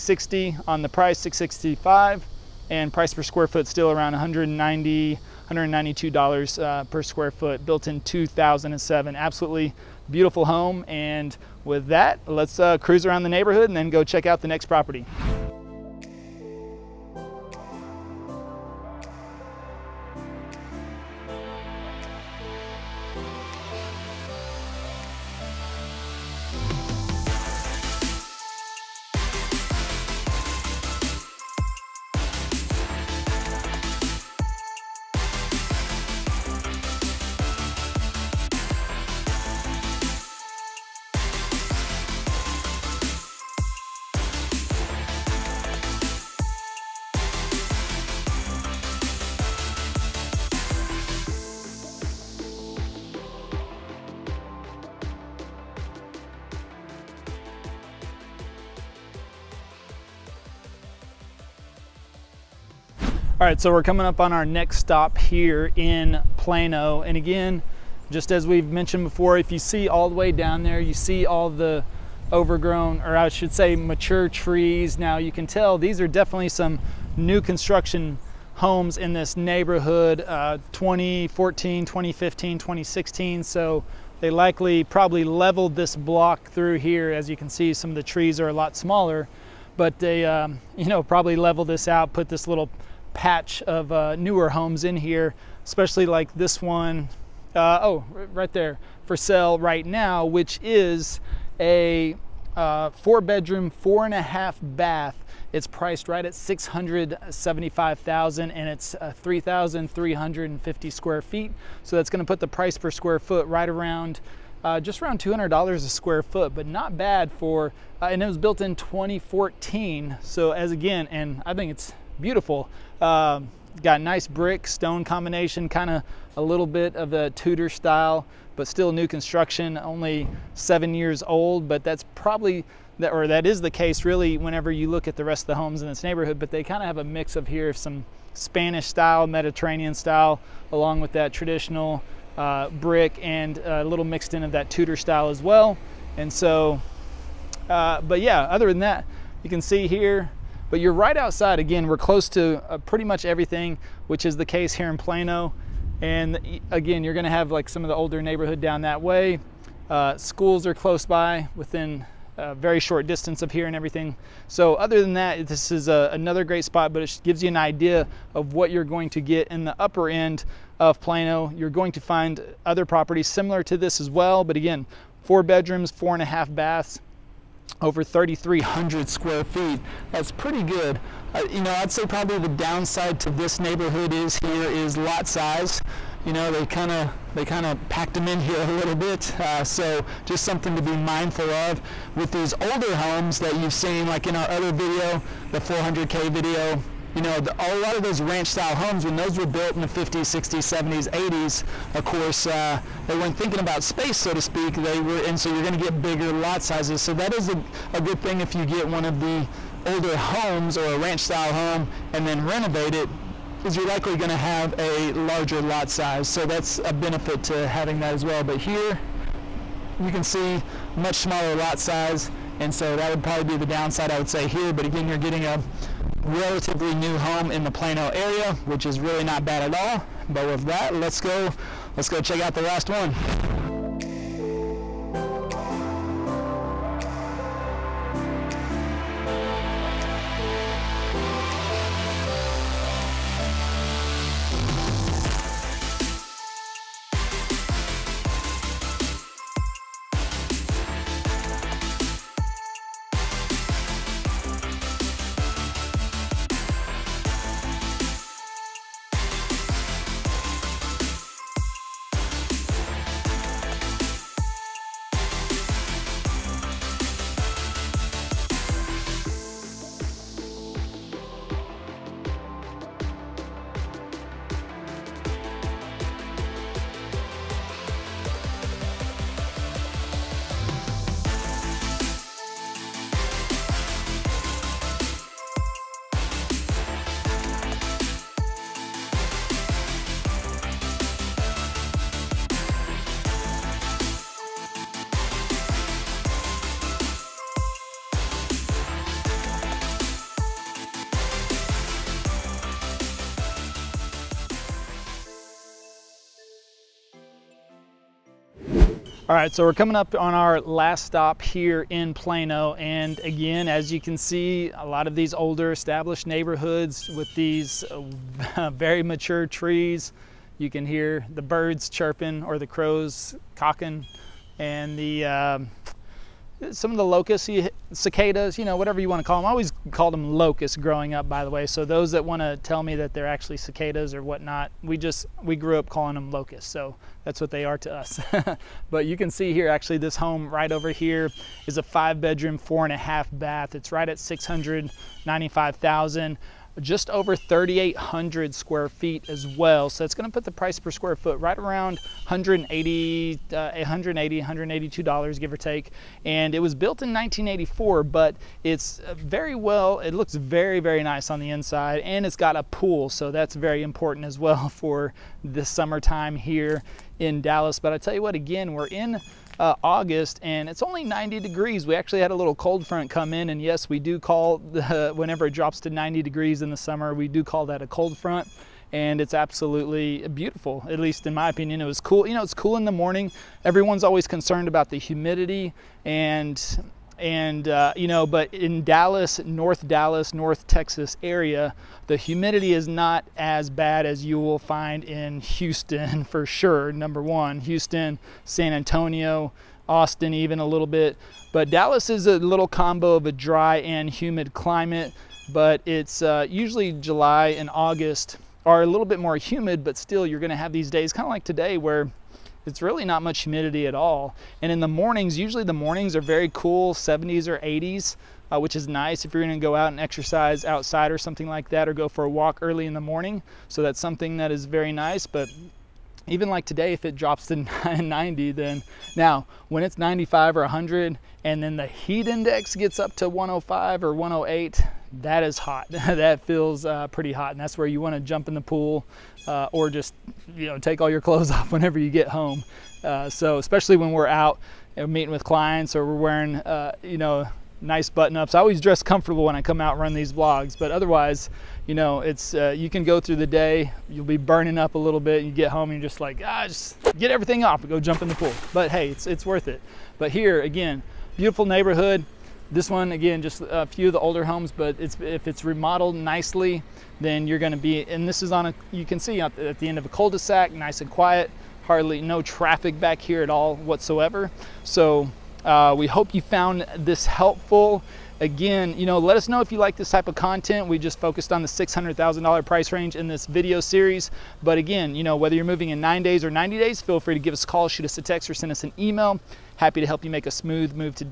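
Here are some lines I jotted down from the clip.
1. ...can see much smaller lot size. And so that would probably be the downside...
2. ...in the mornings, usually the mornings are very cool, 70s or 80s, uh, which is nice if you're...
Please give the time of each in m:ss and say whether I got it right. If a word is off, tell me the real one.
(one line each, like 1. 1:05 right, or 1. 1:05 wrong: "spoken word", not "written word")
1. 3:40 right
2. 6:54 right.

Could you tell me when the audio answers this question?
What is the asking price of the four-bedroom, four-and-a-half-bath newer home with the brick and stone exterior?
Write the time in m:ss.
1:46.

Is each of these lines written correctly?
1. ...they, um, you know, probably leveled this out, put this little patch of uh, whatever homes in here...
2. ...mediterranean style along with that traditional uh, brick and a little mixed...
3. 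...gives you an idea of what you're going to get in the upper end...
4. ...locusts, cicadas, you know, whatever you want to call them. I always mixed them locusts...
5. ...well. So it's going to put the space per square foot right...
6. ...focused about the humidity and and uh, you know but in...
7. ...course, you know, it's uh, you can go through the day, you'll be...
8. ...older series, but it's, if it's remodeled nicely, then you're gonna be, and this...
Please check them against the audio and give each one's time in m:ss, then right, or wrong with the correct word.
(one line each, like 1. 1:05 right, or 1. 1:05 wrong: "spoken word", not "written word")
1. 1:30 wrong: "newer", not "whatever"
2. 2:19 right
3. 2:47 right
4. 5:27 wrong: "called", not "mixed"
5. 5:49 wrong: "price", not "space"
6. 6:24 wrong: "concerned", not "focused"
7. 7:30 wrong: "otherwise", not "course"
8. 7:44 wrong: "homes", not "series".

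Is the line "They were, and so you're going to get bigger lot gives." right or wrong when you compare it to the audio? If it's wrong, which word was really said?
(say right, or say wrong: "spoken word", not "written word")
wrong: "sizes", not "gives".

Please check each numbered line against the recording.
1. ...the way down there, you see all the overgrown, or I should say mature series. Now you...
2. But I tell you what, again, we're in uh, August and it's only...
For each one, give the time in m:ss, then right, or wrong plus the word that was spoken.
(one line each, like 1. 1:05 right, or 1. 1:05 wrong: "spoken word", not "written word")
1. 1:10 wrong: "trees", not "series"
2. 6:07 right.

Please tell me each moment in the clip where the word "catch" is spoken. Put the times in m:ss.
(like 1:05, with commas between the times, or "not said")
not said.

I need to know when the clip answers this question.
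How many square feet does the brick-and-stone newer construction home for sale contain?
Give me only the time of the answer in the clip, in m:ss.
1:49.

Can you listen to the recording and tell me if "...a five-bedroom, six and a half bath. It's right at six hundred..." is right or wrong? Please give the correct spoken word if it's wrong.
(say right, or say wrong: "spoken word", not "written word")
wrong: "four", not "six".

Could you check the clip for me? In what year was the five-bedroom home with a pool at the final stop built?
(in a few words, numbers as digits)
1984.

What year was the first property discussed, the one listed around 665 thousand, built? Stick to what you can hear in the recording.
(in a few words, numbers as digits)
2007.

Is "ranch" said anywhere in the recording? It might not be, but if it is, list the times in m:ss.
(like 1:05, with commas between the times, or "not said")
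3:18, 3:30.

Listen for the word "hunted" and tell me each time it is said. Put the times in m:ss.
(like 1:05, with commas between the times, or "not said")
not said.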